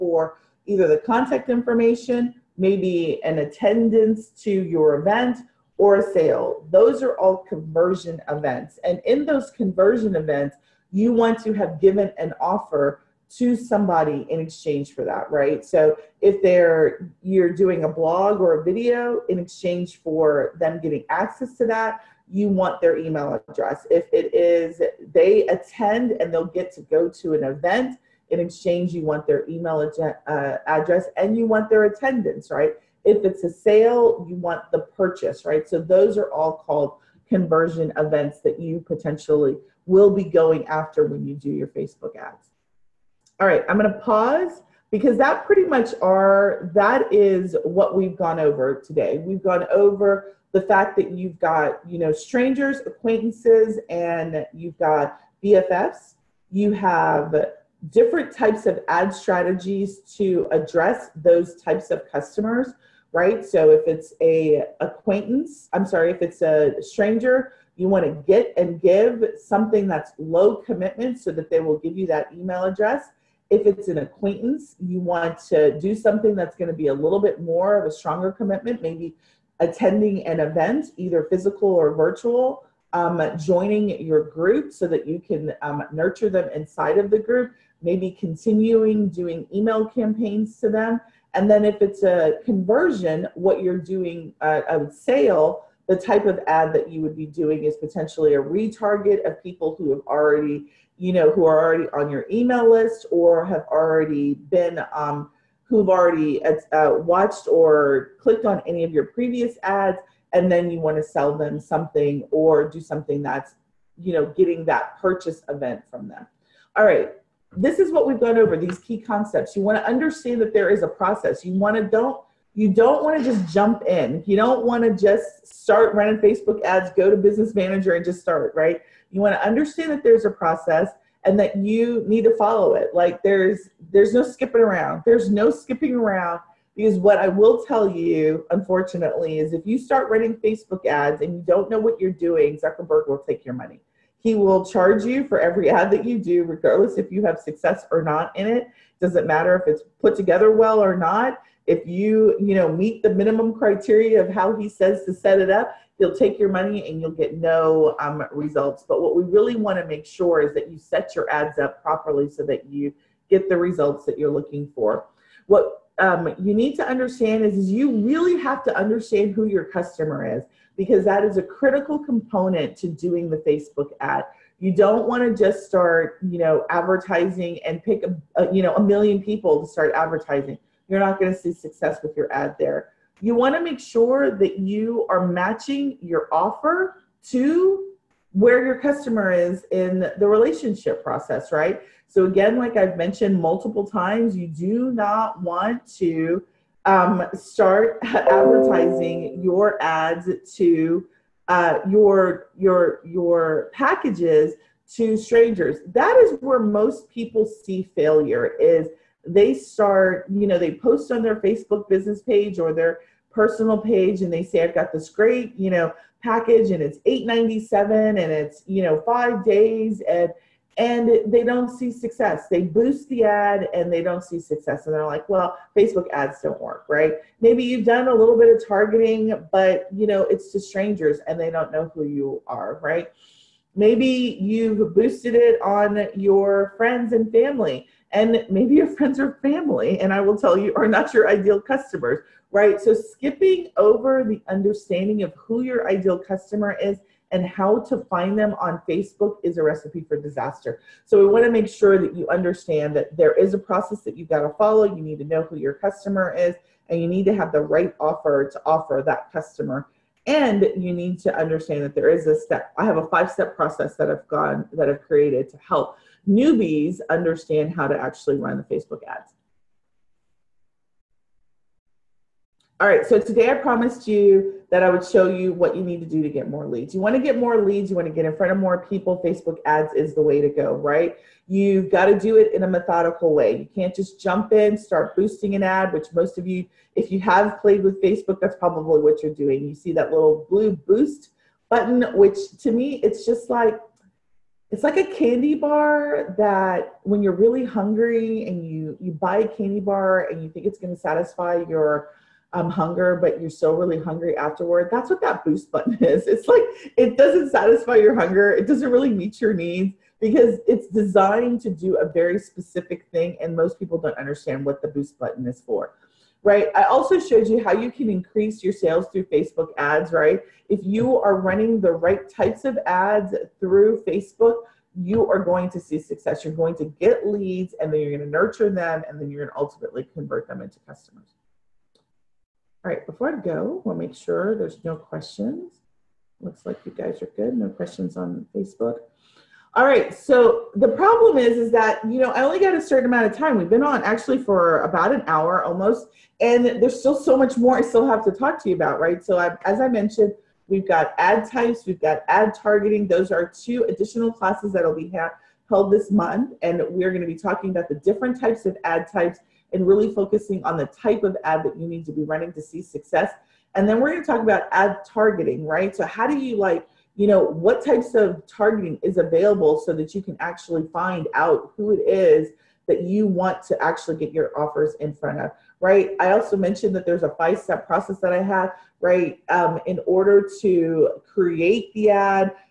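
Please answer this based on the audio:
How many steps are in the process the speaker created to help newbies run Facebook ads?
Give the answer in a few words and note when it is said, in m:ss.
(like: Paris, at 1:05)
5, at 4:23.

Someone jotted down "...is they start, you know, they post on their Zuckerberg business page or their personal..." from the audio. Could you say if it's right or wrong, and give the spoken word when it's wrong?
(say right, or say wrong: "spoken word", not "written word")
wrong: "Facebook", not "Zuckerberg".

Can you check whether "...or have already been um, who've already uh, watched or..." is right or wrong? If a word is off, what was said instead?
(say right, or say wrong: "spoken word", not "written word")
right.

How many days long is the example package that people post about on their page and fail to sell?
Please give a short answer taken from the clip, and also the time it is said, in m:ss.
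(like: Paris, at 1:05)
5 days, at 3:39.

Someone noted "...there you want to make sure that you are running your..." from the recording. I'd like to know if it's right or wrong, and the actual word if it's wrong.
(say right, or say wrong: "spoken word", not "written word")
wrong: "matching", not "running".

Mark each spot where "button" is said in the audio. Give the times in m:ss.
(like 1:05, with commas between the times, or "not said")
4:51, 5:05, 5:15.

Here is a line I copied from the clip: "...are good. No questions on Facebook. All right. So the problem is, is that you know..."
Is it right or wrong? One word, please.
right.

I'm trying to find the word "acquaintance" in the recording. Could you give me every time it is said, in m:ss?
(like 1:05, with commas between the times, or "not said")
0:52, 1:04, 1:13.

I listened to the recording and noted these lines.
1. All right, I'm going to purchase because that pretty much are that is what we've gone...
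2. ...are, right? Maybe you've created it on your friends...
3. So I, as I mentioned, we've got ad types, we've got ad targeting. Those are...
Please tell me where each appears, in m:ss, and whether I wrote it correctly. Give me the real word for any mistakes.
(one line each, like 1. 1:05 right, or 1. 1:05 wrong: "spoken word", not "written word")
1. 0:43 wrong: "pause", not "purchase"
2. 3:52 wrong: "boosted", not "created"
3. 5:49 right.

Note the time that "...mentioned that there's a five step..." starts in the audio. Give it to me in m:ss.
6:16.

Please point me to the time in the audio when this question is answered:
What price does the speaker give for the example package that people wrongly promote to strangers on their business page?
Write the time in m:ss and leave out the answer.
3:37.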